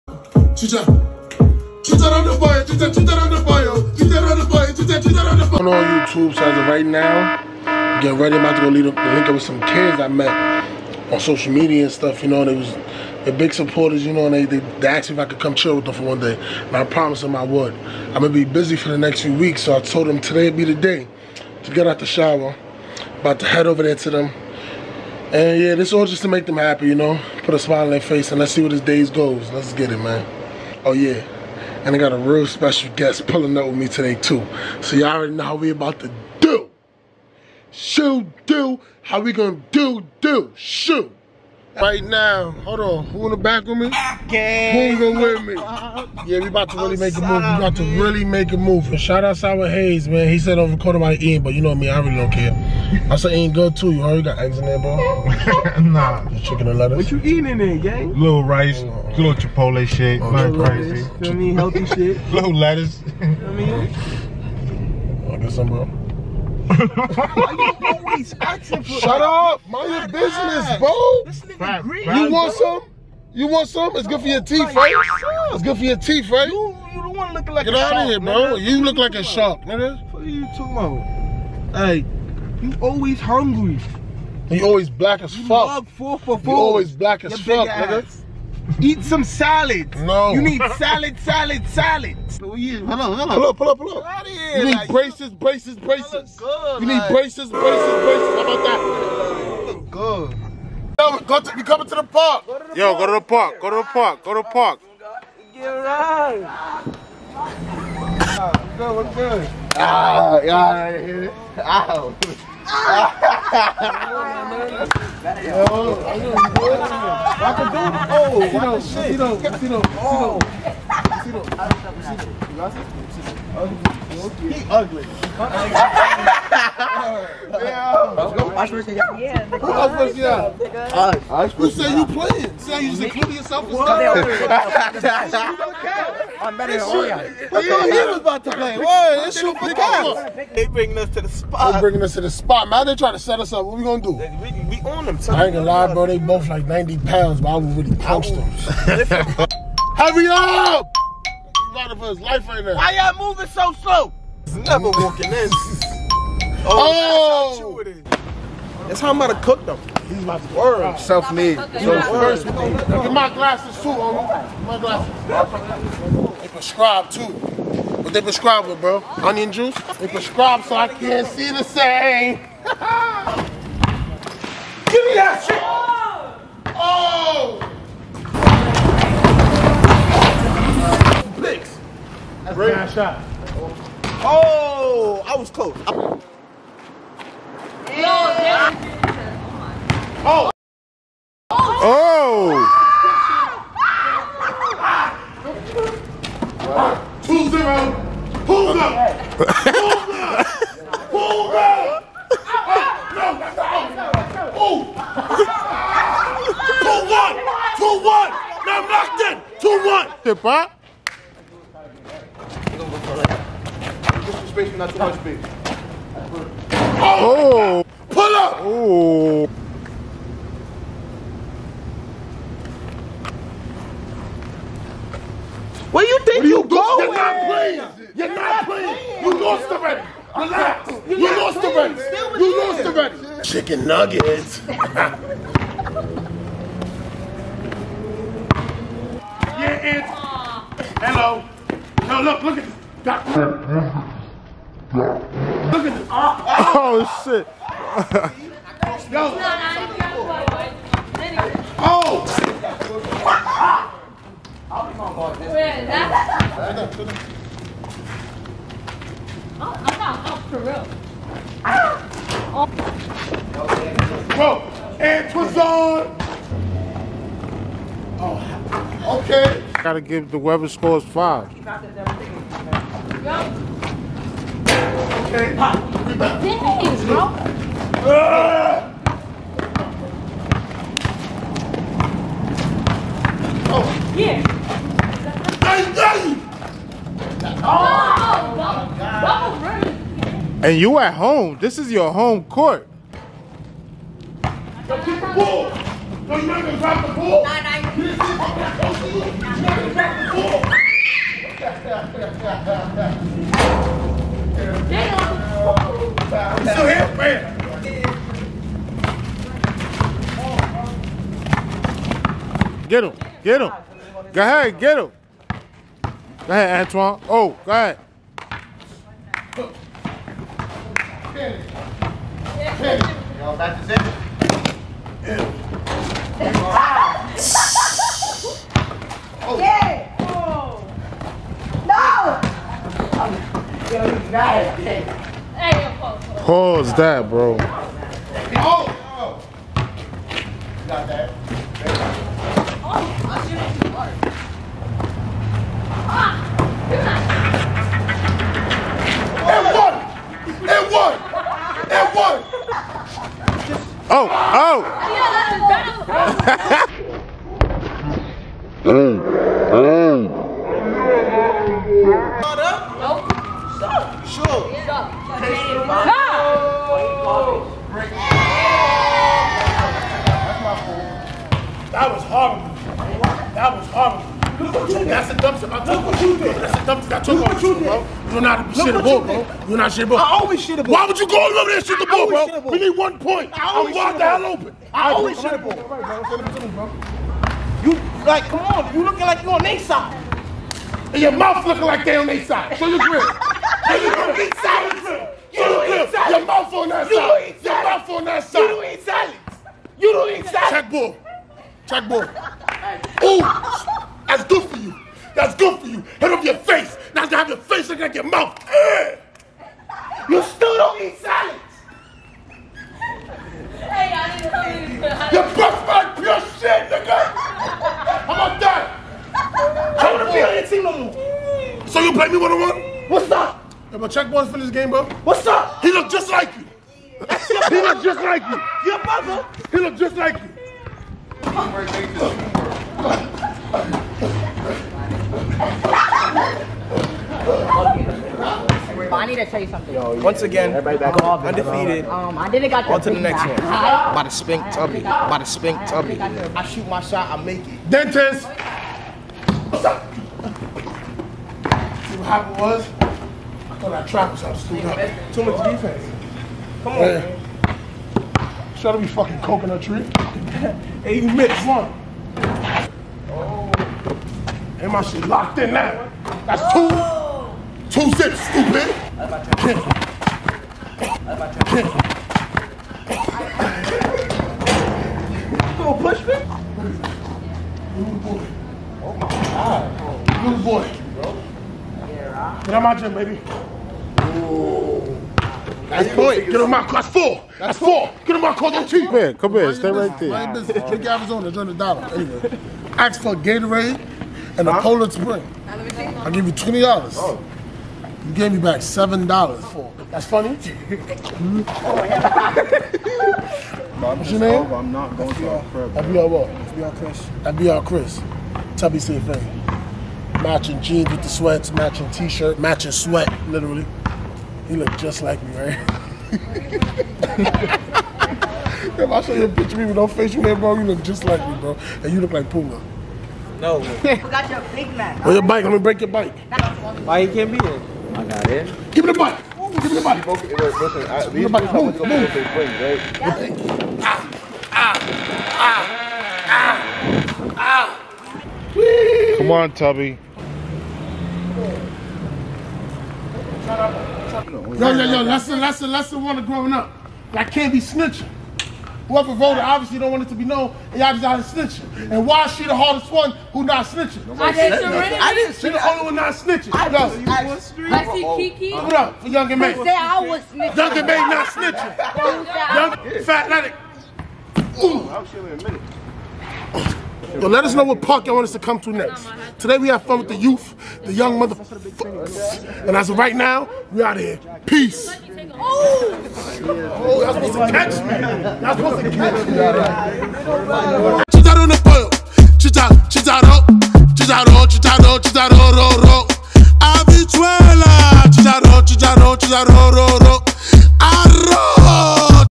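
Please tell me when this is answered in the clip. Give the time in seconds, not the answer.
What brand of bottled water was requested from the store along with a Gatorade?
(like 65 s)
494 s.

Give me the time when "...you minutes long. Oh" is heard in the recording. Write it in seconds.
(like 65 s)
461 s.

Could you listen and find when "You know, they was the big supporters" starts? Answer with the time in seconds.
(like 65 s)
12 s.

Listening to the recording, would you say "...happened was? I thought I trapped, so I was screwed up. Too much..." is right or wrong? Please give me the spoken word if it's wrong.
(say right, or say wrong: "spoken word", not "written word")
right.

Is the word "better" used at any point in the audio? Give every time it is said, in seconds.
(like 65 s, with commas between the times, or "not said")
136 s, 358 s.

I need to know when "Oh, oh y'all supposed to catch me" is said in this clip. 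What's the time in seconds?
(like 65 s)
575 s.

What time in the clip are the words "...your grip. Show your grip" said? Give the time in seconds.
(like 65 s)
392 s.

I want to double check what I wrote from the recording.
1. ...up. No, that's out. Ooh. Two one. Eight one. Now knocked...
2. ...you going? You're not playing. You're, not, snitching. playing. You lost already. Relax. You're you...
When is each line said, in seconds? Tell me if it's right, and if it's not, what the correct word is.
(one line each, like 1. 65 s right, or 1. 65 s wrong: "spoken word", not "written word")
1. 201 s wrong: "Two", not "Eight"
2. 226 s wrong: "playing", not "snitching".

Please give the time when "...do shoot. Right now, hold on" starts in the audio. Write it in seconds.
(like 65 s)
40 s.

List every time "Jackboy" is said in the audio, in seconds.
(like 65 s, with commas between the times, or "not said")
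401 s, 424 s.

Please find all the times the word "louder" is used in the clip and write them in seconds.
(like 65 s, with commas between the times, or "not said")
151 s.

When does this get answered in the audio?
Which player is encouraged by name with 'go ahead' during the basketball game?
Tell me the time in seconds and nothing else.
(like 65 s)
316 s.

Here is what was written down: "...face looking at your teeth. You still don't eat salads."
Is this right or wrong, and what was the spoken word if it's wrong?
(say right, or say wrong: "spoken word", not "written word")
wrong: "mouth", not "teeth".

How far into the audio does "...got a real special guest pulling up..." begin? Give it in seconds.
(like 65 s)
31 s.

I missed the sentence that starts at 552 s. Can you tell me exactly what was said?
And why is she the hardest one who not snitching?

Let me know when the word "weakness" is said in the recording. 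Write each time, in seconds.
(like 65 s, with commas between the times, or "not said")
not said.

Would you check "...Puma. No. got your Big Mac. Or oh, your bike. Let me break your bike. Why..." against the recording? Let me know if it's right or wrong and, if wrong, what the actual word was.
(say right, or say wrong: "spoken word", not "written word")
right.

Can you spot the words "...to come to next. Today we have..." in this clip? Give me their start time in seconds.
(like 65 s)
568 s.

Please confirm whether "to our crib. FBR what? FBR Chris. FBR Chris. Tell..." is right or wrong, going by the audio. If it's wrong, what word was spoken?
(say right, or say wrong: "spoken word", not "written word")
right.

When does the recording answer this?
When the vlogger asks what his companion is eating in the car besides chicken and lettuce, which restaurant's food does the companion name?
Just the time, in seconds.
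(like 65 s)
59 s.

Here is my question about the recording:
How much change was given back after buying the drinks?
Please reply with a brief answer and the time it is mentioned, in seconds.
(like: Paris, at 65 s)
7 dollars, at 498 s.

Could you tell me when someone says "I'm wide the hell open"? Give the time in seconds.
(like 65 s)
383 s.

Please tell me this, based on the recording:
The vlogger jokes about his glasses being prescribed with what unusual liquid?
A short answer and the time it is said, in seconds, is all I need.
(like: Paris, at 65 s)
Onion juice, at 169 s.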